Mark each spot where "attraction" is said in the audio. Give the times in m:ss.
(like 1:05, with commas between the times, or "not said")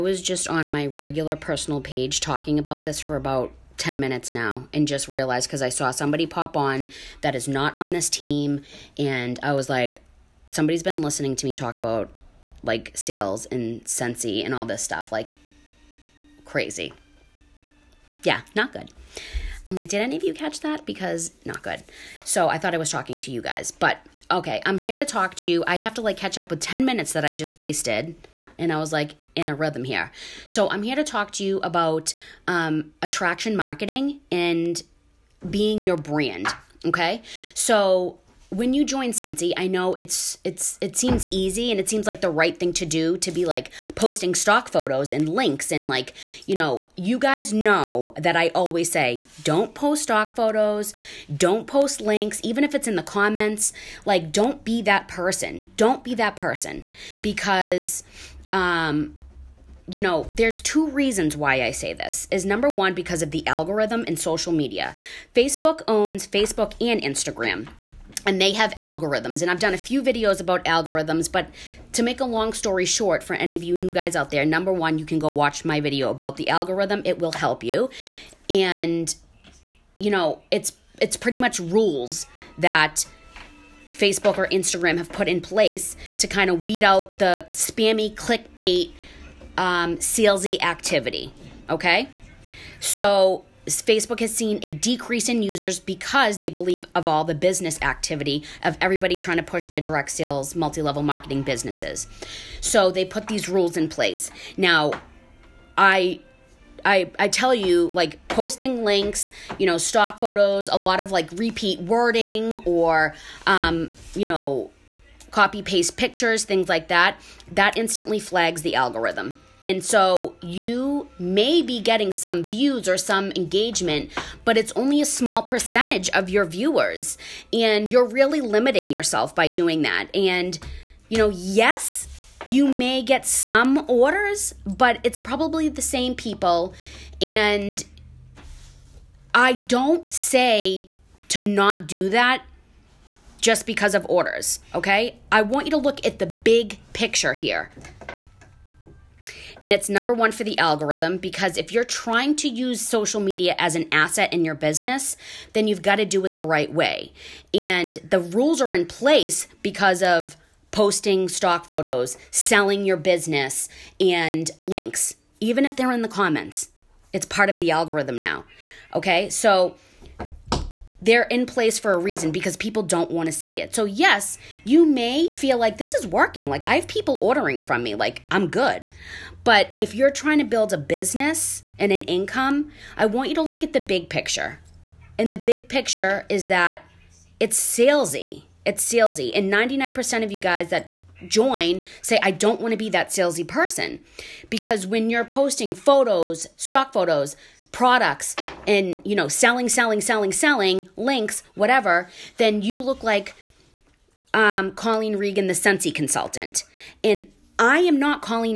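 0:33.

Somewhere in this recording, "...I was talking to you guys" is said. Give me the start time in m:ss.
0:22.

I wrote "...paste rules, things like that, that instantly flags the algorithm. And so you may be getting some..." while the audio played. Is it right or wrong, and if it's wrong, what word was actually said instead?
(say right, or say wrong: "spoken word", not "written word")
wrong: "pictures", not "rules".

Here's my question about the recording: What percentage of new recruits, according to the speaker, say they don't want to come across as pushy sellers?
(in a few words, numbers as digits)
99%.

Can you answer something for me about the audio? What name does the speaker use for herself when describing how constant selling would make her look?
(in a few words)
Colleen Regan.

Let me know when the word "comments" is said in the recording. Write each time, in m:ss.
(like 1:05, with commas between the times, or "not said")
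0:53, 2:46.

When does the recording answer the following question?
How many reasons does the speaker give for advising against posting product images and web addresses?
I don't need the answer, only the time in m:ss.
1:00.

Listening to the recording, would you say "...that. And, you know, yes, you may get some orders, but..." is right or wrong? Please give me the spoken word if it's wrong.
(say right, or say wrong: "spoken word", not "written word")
right.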